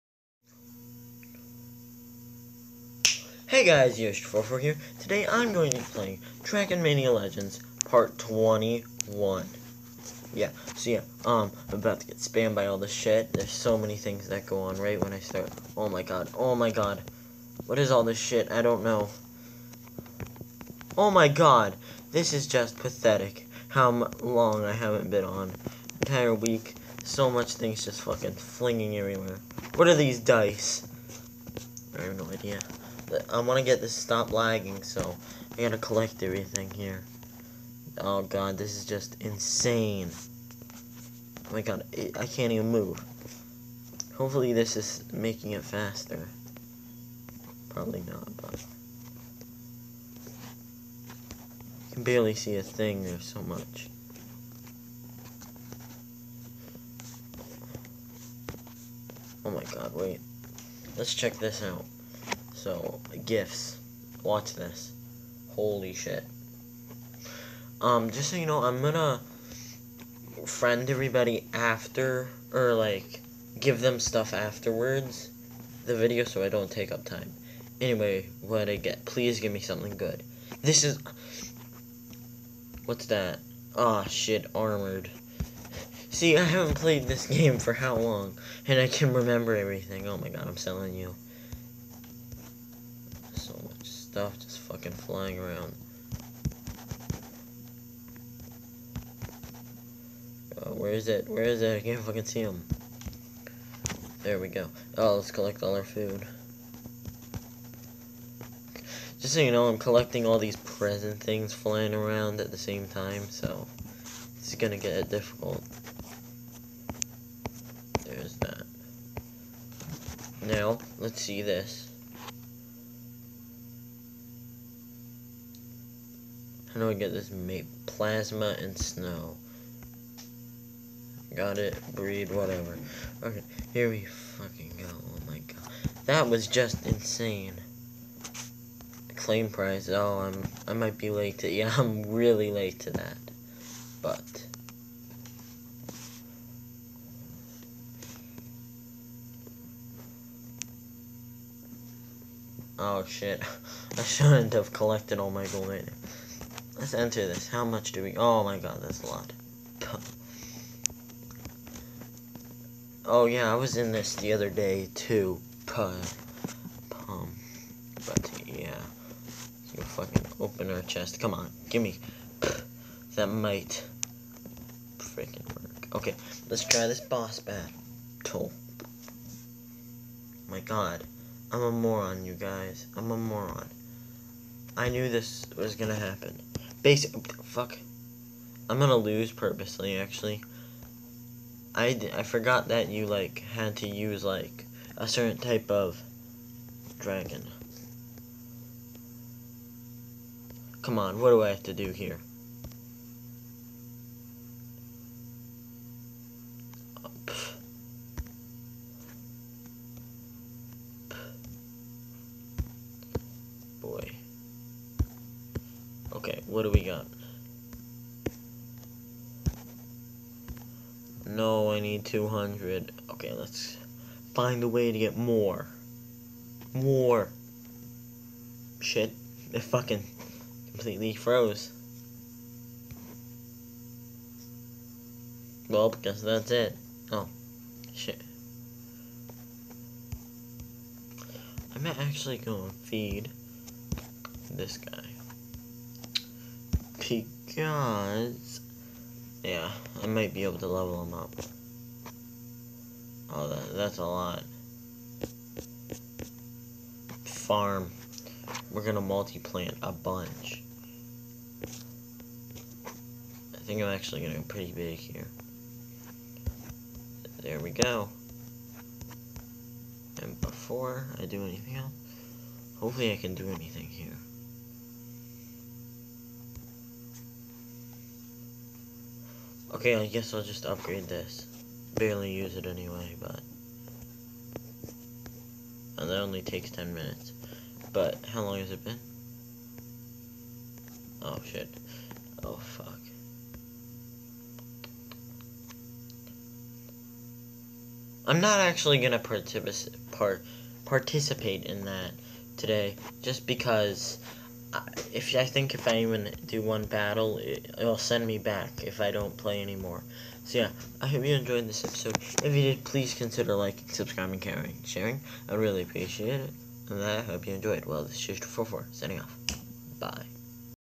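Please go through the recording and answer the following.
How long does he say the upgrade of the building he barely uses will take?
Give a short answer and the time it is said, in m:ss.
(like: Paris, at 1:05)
10 minutes, at 4:46.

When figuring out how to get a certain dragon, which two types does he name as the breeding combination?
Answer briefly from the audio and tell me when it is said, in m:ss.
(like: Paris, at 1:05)
Plasma and snow, at 2:07.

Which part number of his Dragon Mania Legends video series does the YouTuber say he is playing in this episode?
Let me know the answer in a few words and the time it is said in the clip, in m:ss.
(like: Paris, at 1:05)
21, at 0:07.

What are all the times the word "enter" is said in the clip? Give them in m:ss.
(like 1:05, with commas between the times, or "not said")
2:36.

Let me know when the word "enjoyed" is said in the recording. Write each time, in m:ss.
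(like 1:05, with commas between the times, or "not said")
5:11, 5:17.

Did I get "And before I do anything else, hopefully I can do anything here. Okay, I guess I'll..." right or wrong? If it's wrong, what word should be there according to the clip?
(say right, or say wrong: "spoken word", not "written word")
right.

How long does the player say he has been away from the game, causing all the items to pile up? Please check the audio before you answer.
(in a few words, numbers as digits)
Entire week.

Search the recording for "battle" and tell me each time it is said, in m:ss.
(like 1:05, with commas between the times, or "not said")
2:57, 5:06.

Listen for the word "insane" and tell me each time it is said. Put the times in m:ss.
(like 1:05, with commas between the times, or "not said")
0:39, 2:16.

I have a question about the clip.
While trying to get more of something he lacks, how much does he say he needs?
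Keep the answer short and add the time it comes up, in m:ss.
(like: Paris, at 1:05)
200, at 3:42.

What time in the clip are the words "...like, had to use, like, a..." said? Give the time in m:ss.
3:13.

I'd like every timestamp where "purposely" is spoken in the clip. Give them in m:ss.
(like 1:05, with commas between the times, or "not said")
3:09.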